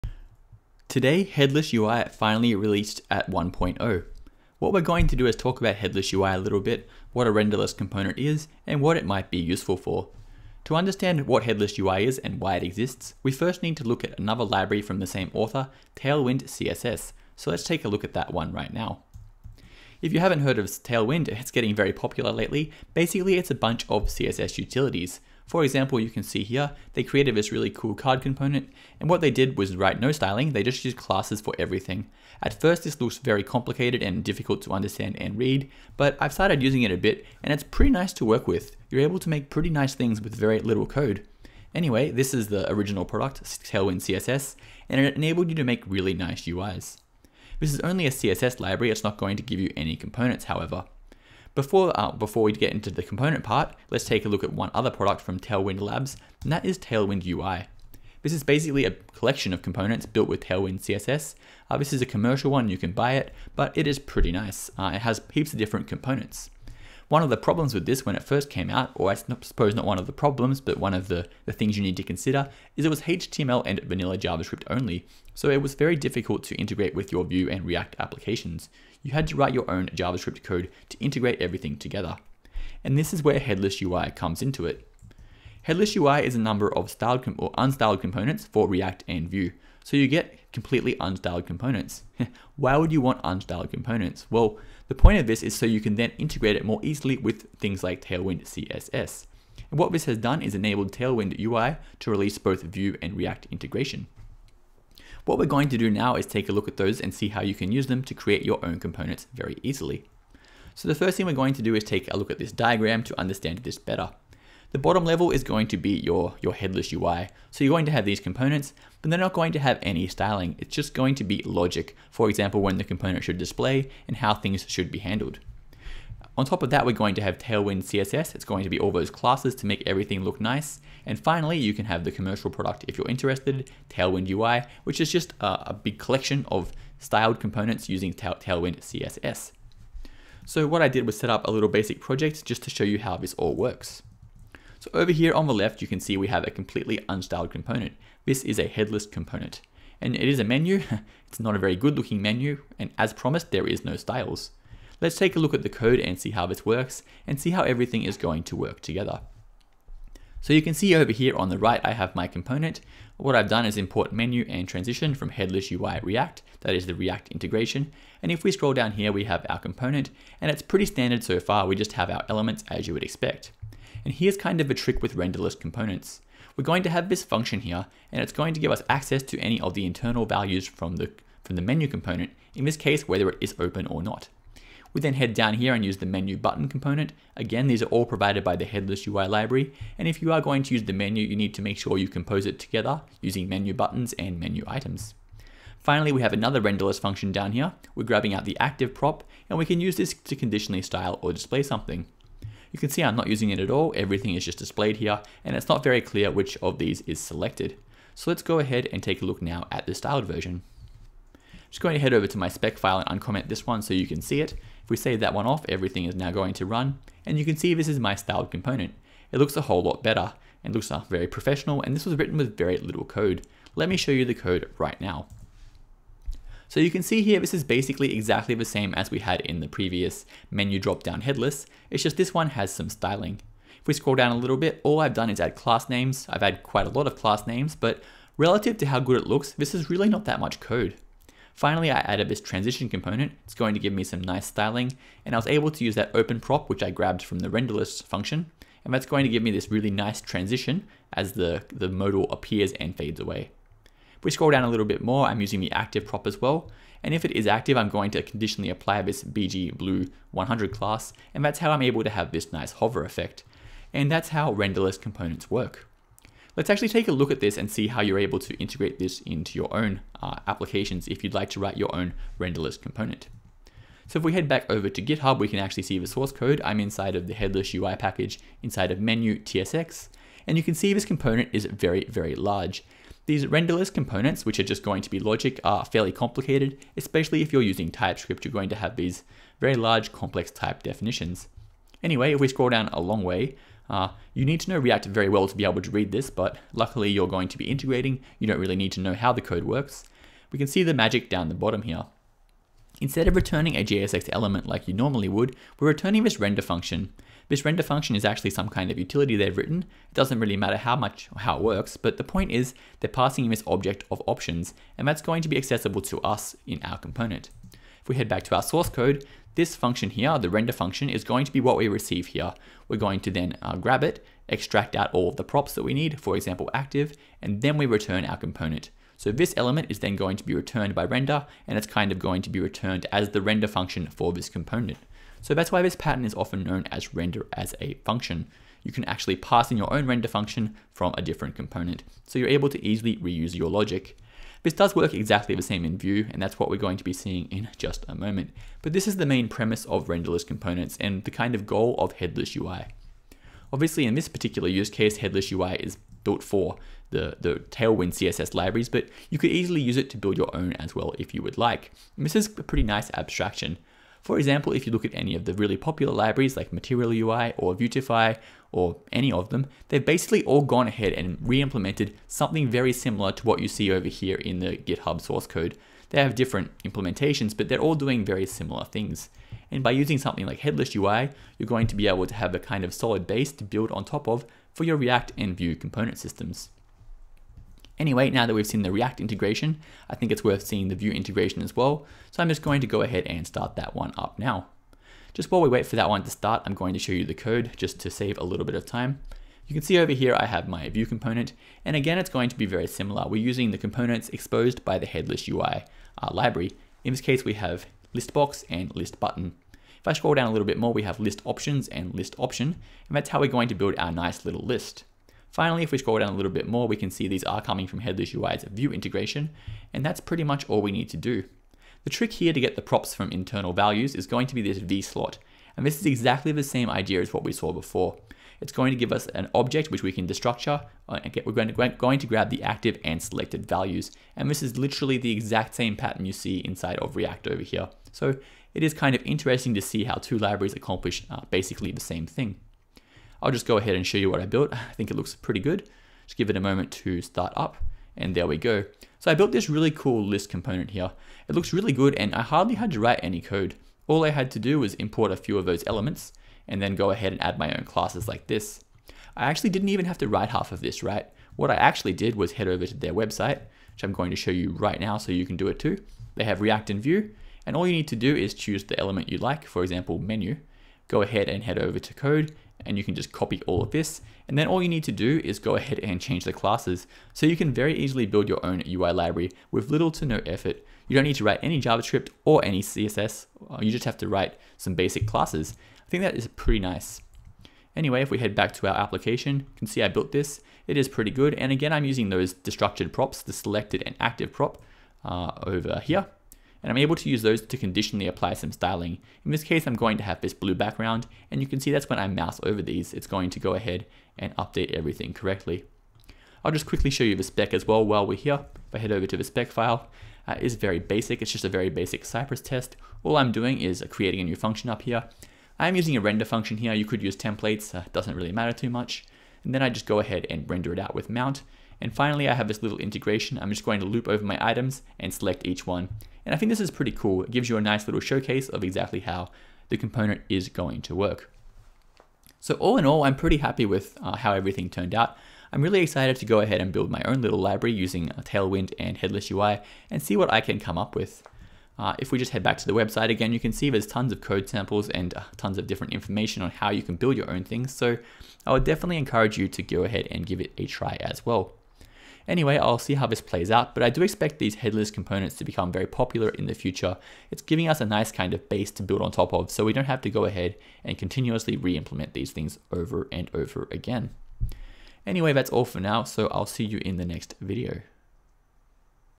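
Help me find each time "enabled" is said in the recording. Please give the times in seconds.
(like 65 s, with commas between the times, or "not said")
45 s, 100 s.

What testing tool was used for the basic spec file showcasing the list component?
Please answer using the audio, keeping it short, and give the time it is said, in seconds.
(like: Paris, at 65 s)
Cypress, at 512 s.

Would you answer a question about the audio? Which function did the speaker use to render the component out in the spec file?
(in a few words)
mount.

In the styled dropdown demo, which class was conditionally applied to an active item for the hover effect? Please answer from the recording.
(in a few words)
BG blue 100.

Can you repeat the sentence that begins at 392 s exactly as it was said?
So I'm just going to go ahead and start that one up now.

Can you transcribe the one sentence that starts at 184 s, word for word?
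We then head down here and use the menu button component.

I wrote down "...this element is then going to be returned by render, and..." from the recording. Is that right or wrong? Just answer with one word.
right.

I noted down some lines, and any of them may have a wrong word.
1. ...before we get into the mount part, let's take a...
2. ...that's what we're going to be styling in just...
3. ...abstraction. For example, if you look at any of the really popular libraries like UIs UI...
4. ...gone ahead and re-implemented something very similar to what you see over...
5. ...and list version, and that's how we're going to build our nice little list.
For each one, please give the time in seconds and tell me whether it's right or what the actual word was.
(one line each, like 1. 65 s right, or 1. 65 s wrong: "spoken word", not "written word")
1. 52 s wrong: "component", not "mount"
2. 346 s wrong: "seeing", not "styling"
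3. 363 s wrong: "Material", not "UIs"
4. 370 s right
5. 411 s wrong: "option", not "version".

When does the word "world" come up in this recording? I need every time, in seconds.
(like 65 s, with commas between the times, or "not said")
not said.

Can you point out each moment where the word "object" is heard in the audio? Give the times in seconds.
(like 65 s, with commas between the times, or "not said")
313 s, 429 s.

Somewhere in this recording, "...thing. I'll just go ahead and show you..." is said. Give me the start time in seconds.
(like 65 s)
442 s.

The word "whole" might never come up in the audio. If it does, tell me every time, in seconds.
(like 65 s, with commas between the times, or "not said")
219 s.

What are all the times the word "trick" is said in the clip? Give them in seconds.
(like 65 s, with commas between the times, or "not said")
174 s, 422 s.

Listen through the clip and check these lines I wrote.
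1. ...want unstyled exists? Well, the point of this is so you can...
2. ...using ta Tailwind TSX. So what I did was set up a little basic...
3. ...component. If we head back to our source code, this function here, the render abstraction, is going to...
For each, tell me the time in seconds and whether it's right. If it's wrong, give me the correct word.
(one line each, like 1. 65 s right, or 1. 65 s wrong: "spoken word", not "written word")
1. 92 s wrong: "components", not "exists"
2. 137 s wrong: "CSS", not "TSX"
3. 316 s wrong: "function", not "abstraction".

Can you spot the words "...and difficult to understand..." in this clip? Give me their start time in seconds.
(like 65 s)
34 s.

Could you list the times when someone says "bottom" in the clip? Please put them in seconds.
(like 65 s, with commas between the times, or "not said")
114 s, 301 s.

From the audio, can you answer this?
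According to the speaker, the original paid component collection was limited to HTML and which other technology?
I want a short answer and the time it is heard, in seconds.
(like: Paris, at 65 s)
vanilla JavaScript, at 73 s.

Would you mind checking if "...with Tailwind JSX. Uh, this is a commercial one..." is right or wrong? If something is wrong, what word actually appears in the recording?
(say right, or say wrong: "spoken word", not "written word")
wrong: "CSS", not "JSX".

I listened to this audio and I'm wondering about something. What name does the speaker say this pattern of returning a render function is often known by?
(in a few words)
render as a function.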